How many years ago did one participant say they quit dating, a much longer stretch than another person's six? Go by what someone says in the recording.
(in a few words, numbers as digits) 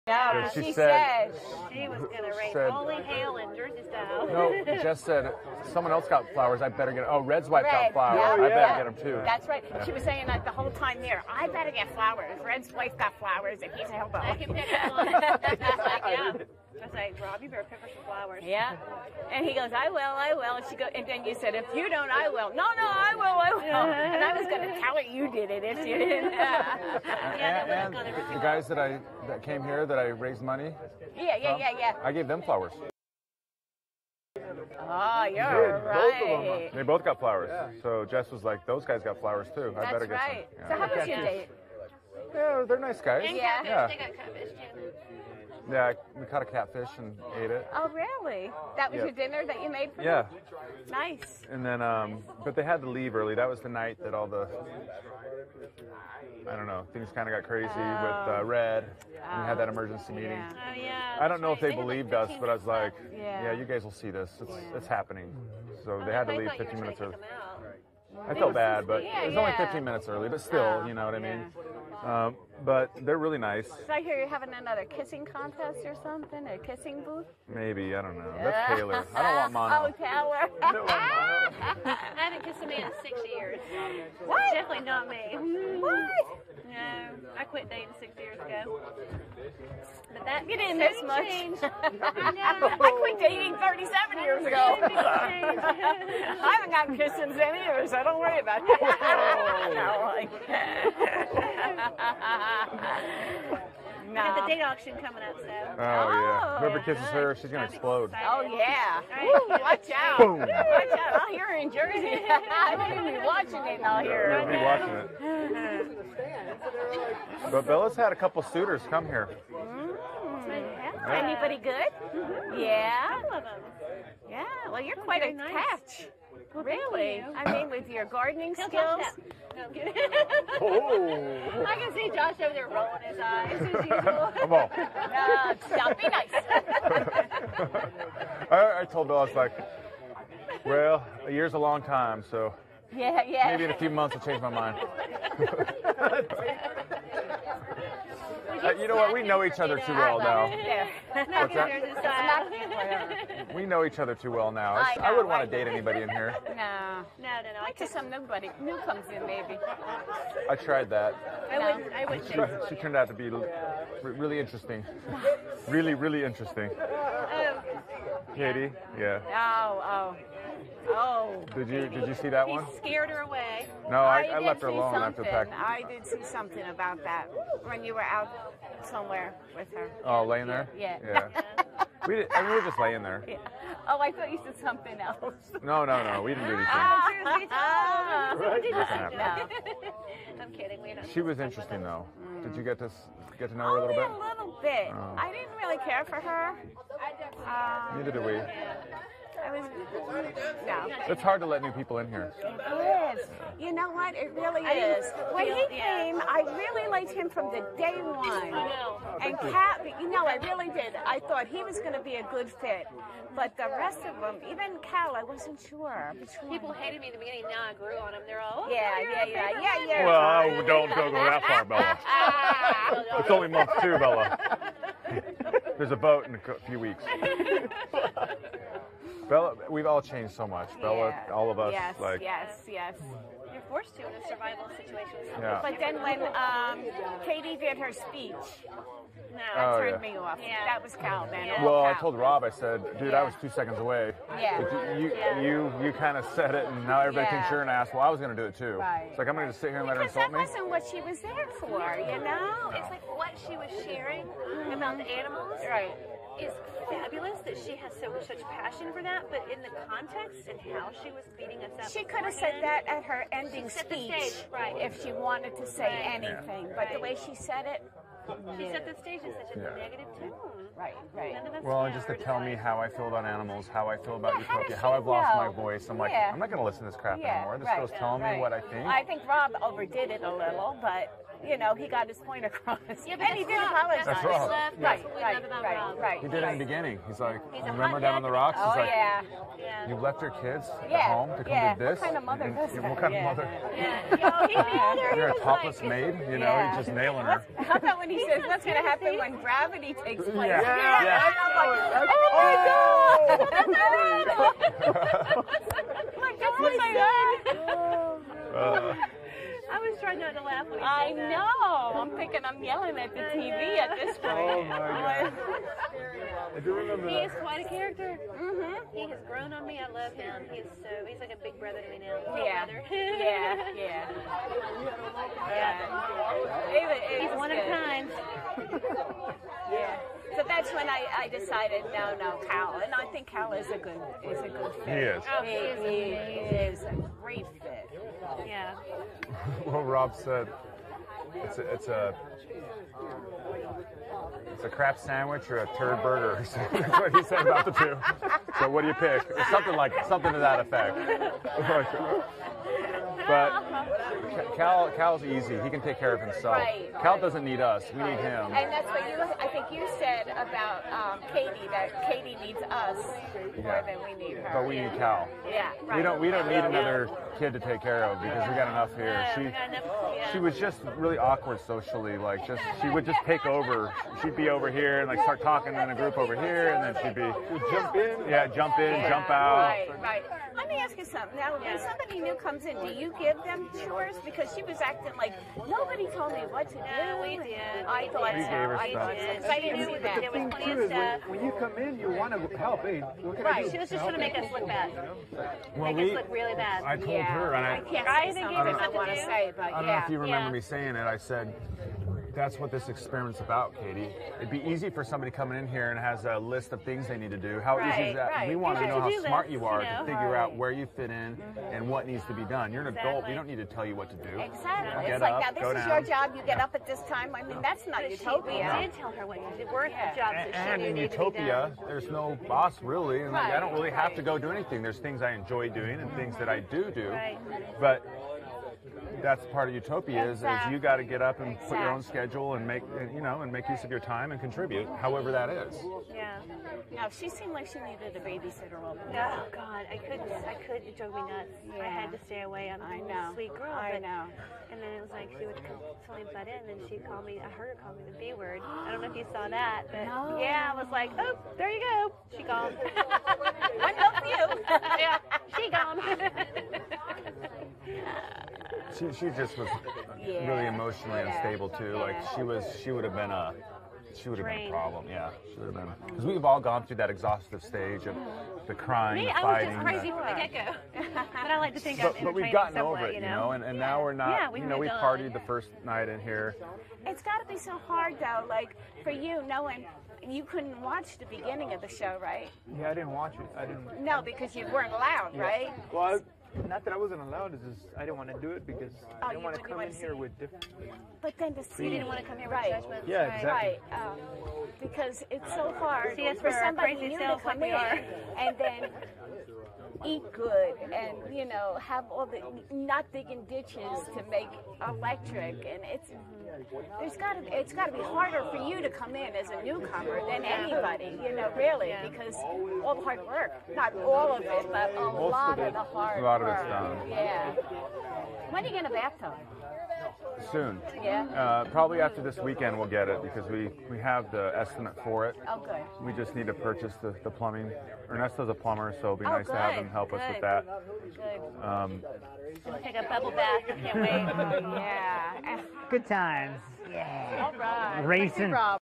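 37.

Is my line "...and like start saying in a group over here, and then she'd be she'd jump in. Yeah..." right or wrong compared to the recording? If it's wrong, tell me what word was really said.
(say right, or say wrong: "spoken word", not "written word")
wrong: "talking", not "saying".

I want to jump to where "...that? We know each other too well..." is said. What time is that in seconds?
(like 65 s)
151 s.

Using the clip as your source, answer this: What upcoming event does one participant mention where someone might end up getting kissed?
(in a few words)
date auction.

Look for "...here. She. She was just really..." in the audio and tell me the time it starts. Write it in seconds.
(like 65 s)
368 s.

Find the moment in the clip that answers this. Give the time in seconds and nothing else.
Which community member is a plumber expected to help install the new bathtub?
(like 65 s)
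528 s.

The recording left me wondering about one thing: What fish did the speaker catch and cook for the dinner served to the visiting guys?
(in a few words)
catfish.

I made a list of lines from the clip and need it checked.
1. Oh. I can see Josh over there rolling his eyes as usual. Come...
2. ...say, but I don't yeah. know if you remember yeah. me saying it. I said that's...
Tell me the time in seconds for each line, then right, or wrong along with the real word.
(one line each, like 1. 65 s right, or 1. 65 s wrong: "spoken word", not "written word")
1. 130 s right
2. 399 s right.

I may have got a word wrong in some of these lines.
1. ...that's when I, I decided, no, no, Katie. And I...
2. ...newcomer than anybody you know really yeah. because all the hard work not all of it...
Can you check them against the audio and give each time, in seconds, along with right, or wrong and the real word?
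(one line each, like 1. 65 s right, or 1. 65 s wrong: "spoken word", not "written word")
1. 330 s wrong: "Cal", not "Katie"
2. 509 s right.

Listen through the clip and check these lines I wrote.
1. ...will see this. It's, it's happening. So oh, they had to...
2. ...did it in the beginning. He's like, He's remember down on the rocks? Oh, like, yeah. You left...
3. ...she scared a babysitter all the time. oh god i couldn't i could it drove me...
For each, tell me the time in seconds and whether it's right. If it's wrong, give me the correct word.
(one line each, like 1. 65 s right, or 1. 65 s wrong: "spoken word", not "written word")
1. 63 s right
2. 286 s right
3. 437 s wrong: "needed", not "scared".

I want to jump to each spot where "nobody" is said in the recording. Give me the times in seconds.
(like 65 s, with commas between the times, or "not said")
158 s, 385 s.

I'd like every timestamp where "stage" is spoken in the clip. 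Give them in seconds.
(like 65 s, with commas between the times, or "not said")
264 s, 269 s, 467 s.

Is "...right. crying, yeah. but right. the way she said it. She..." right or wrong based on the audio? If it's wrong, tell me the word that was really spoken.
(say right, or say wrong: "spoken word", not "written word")
wrong: "anything", not "crying".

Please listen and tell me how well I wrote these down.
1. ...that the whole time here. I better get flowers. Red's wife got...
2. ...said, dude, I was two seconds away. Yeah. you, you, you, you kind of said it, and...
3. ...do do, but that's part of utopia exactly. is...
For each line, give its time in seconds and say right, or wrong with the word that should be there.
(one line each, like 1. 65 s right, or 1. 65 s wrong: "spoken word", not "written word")
1. 10 s right
2. 242 s right
3. 426 s right.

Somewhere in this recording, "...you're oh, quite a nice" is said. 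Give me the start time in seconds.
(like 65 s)
124 s.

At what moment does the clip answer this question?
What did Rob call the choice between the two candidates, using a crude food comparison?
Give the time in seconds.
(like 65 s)
344 s.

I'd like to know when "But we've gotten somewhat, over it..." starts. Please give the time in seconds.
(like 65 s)
472 s.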